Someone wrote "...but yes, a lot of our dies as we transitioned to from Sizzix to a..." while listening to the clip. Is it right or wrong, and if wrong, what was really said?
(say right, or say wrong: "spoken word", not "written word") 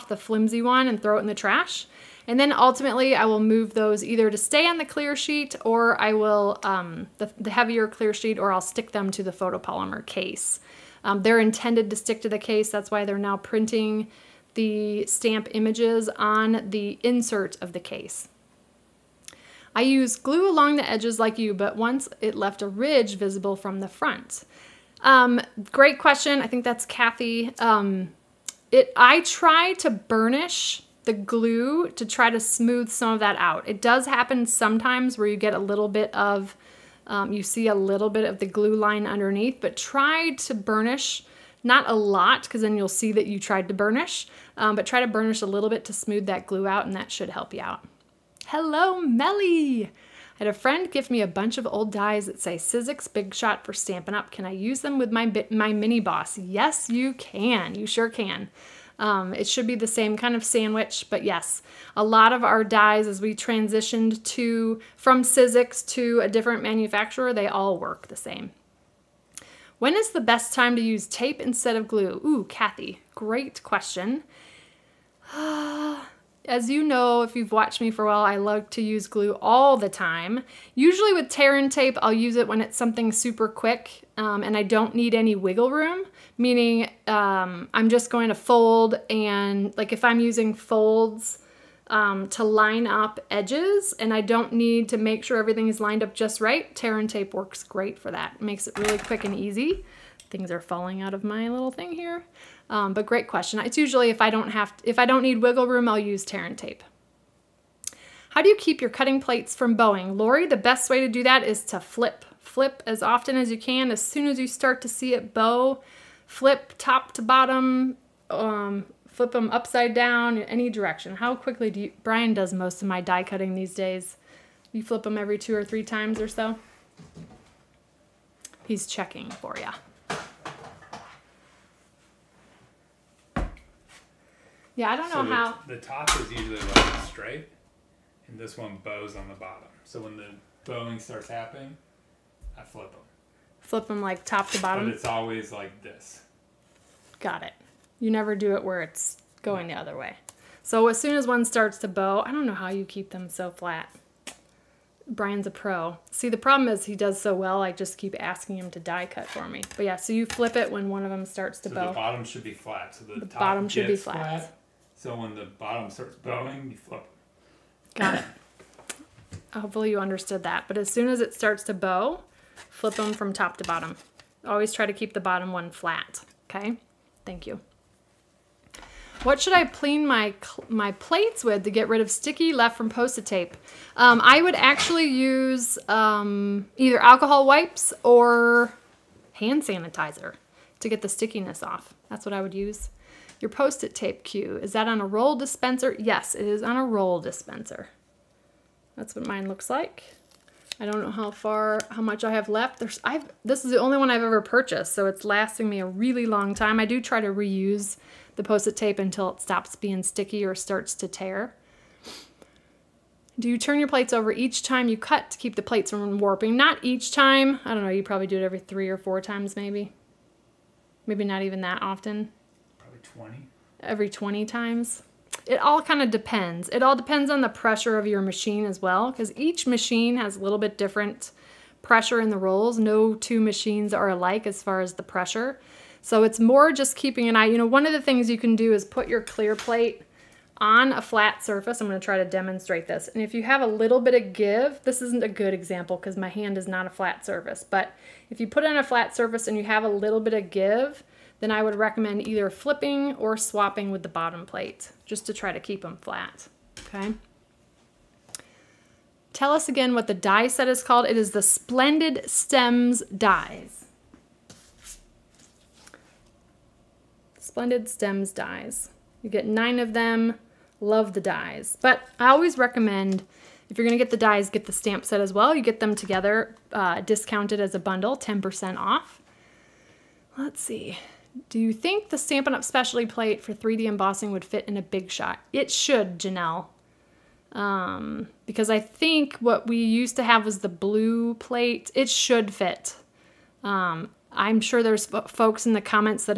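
right.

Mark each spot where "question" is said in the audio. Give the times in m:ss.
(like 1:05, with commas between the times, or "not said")
0:25, 1:13, 1:43.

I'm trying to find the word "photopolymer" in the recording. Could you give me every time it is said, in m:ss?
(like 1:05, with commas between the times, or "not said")
0:09.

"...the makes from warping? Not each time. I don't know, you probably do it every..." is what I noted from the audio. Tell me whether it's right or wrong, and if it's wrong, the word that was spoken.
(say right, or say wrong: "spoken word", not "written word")
wrong: "plates", not "makes".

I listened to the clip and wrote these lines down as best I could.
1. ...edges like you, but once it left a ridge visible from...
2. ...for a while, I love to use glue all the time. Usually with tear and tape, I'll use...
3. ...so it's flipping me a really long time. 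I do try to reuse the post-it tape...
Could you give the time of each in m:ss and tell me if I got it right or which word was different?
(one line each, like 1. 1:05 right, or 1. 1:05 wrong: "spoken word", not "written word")
1. 0:20 right
2. 1:17 right
3. 3:24 wrong: "lasting", not "flipping".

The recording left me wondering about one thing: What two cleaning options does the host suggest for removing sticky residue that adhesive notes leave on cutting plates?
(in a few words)
Alcohol wipes or hand sanitizer.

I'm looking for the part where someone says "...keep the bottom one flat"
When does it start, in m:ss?
2:54.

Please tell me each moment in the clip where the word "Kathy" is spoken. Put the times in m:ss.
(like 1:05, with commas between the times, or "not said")
0:26, 1:12.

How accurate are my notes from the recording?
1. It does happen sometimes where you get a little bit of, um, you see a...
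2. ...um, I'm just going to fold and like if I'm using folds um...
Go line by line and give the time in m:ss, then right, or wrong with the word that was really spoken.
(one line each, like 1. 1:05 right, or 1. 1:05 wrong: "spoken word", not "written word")
1. 0:33 right
2. 1:27 right.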